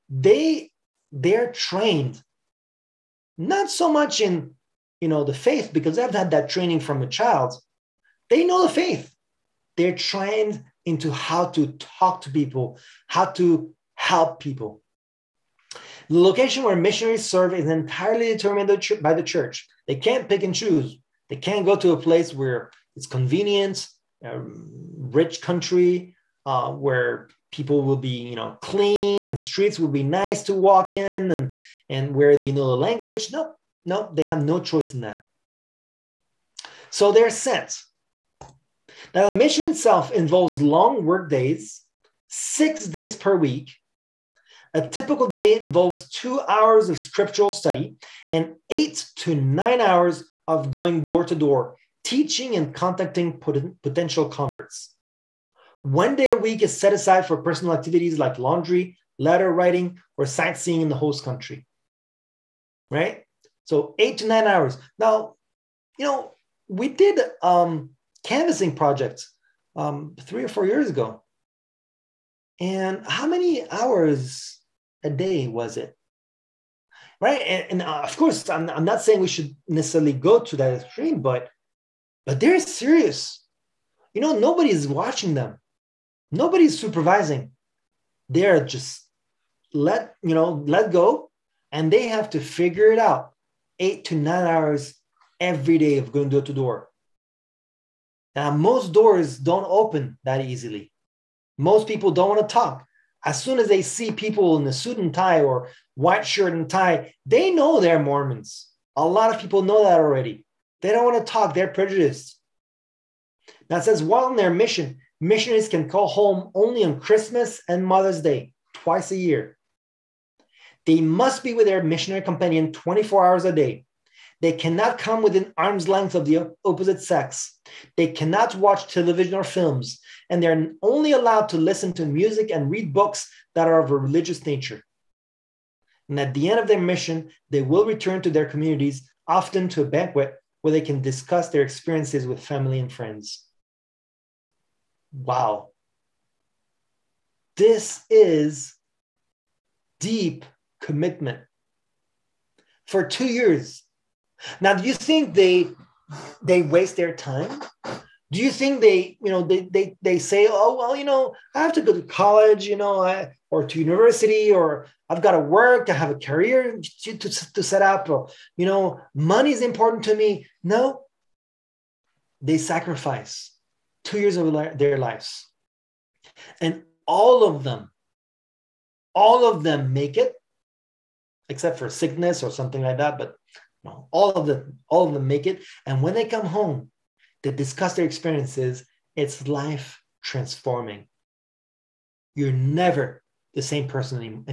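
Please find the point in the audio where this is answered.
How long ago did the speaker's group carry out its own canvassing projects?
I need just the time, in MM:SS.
01:10.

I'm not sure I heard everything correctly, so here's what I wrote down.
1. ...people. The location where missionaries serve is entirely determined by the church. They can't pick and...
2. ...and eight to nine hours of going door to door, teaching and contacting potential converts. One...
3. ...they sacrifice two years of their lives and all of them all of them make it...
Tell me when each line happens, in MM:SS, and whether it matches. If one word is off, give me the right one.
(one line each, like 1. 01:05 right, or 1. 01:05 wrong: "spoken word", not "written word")
1. 00:14 right
2. 00:48 right
3. 02:52 right.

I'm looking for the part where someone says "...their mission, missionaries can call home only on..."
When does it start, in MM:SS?
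01:54.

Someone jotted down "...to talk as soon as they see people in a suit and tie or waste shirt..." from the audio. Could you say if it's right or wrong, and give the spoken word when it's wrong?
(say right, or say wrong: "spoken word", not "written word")
wrong: "white", not "waste".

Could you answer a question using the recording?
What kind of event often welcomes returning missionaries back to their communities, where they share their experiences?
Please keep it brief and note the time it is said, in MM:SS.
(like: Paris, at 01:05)
A banquet, at 02:19.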